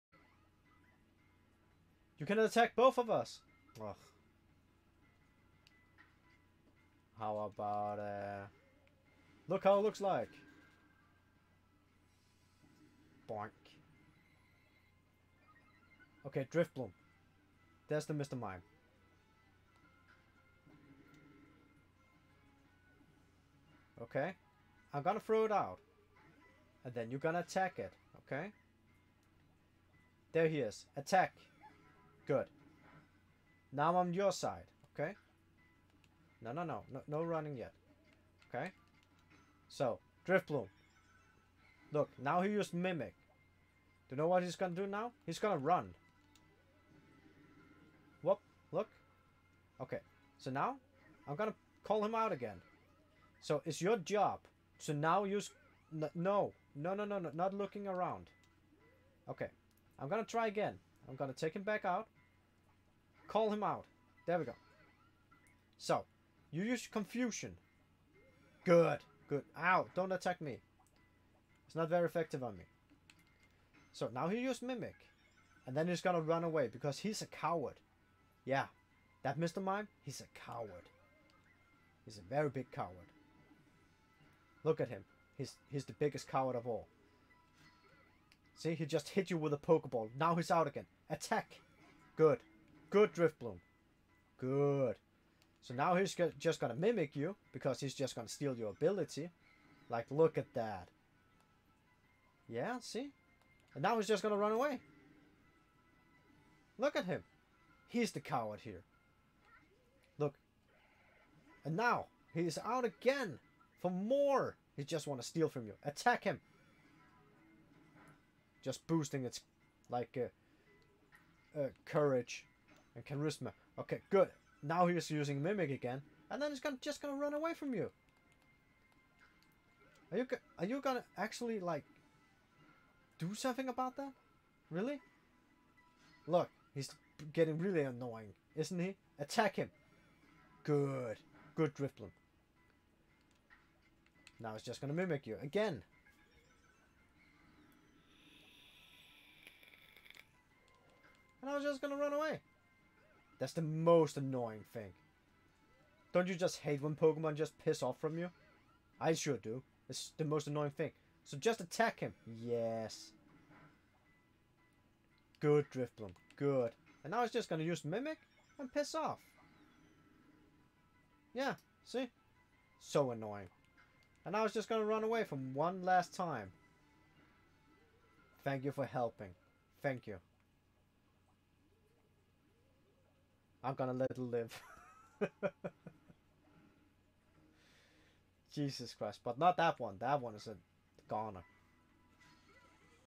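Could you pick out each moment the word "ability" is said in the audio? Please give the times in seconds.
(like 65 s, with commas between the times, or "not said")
98 s.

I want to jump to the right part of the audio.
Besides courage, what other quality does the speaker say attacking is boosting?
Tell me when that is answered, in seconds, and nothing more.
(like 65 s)
123 s.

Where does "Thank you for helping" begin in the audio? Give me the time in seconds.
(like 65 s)
178 s.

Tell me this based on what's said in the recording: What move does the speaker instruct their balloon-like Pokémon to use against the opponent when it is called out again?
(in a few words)
Confusion.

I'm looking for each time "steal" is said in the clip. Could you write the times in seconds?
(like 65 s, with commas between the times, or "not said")
98 s, 115 s.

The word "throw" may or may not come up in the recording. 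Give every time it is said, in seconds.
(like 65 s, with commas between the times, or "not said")
25 s.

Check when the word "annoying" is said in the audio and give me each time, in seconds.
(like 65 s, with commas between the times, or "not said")
137 s, 154 s, 160 s, 173 s.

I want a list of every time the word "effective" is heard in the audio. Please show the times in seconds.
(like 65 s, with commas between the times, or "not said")
72 s.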